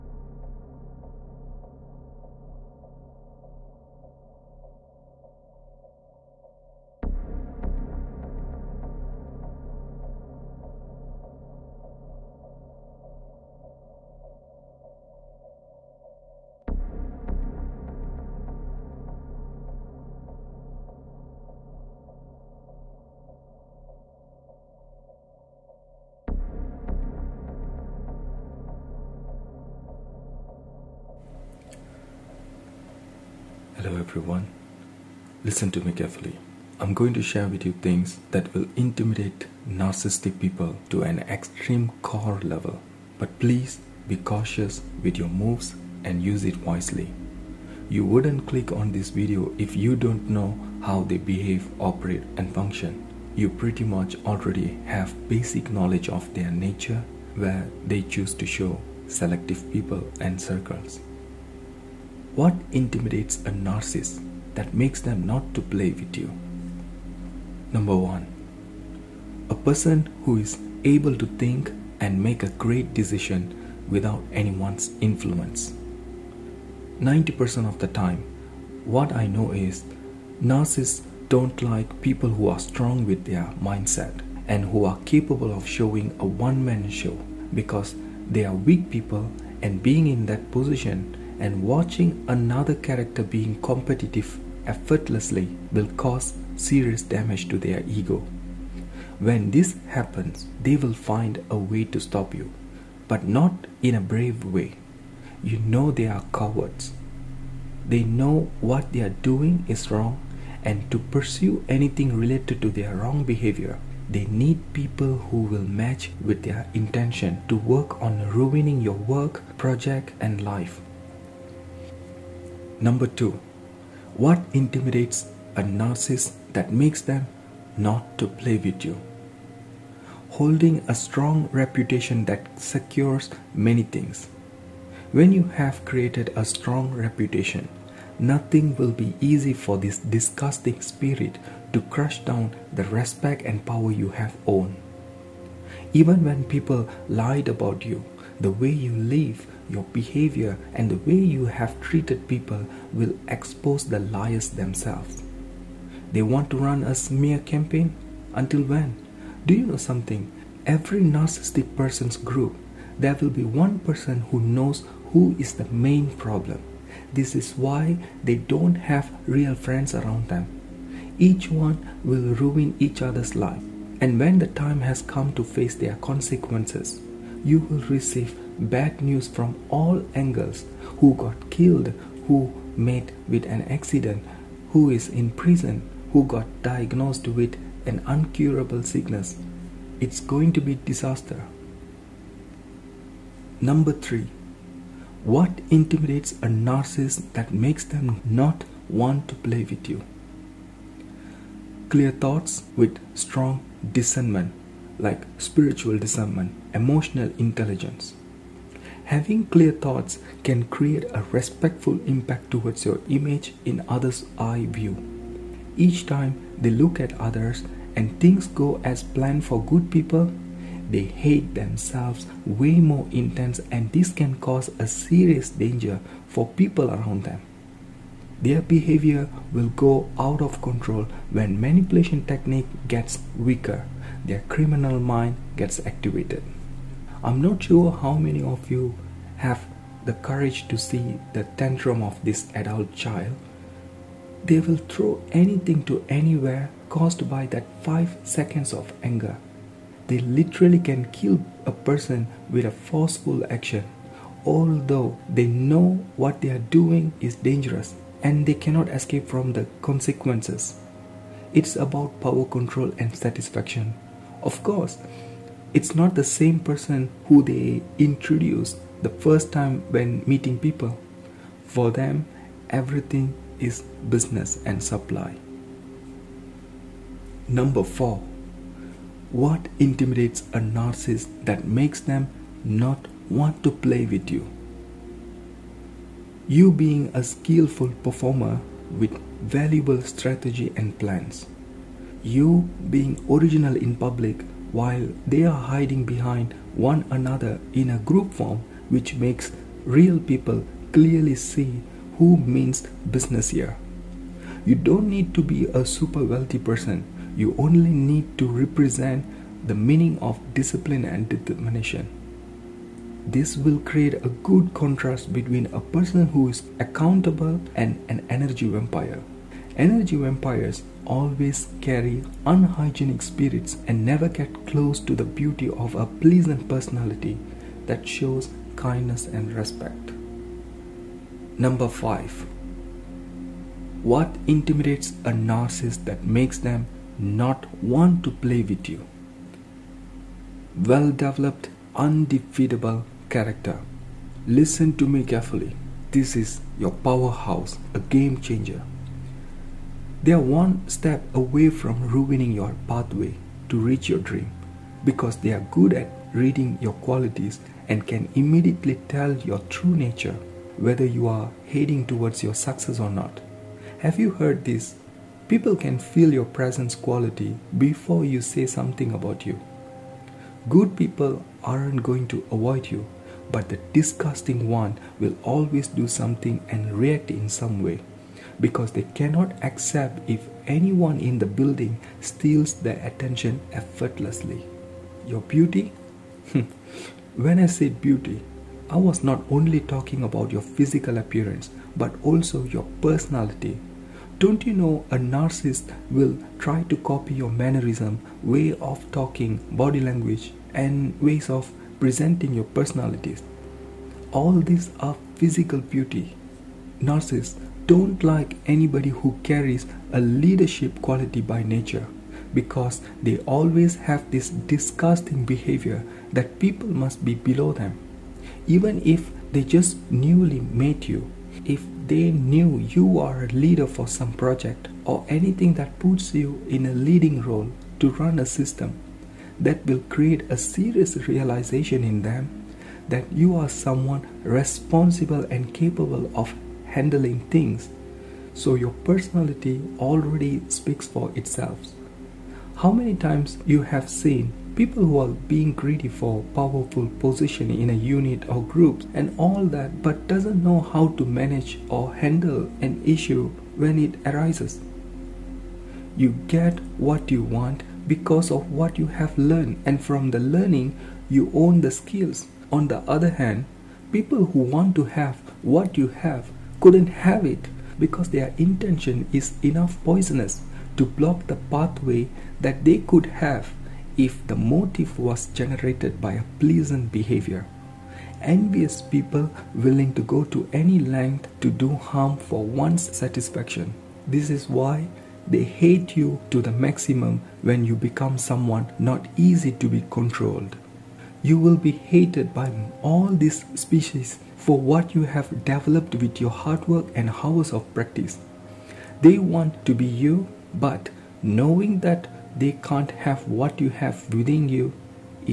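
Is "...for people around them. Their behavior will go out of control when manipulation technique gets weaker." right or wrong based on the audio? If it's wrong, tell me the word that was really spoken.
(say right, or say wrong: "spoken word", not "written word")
right.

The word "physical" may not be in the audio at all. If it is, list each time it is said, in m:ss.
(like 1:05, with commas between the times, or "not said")
6:30, 6:45.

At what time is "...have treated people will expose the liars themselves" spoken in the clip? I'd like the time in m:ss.
2:31.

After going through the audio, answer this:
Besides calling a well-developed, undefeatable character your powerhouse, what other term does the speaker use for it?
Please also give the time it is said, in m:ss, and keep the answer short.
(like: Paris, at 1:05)
game changer, at 5:47.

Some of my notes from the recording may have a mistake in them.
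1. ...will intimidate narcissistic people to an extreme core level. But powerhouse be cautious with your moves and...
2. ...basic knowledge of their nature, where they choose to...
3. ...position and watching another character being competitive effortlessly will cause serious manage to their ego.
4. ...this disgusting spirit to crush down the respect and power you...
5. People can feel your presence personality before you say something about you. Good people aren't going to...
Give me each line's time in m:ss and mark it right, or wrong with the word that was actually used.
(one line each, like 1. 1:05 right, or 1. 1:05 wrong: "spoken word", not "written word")
1. 0:38 wrong: "please", not "powerhouse"
2. 0:55 right
3. 1:30 wrong: "damage", not "manage"
4. 2:19 right
5. 6:05 wrong: "quality", not "personality".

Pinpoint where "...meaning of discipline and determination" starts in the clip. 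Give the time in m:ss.
5:09.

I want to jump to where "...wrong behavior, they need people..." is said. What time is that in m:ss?
1:52.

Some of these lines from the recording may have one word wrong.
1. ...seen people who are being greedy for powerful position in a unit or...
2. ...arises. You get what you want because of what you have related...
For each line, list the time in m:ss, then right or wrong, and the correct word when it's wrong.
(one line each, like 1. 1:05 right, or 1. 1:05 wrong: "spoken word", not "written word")
1. 7:24 right
2. 7:34 wrong: "learned", not "related".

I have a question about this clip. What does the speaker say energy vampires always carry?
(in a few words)
unhygienic spirits.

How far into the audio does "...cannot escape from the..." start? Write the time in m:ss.
4:18.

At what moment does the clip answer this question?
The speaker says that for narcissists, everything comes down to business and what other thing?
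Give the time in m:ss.
4:34.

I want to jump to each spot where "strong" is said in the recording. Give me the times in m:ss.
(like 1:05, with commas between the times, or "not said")
1:22, 2:10, 2:16, 3:23.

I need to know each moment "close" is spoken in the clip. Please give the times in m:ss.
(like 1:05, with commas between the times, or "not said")
5:24.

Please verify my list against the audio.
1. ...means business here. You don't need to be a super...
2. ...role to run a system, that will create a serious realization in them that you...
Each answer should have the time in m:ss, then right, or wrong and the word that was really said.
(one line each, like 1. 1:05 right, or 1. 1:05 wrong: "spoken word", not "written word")
1. 5:02 right
2. 7:07 right.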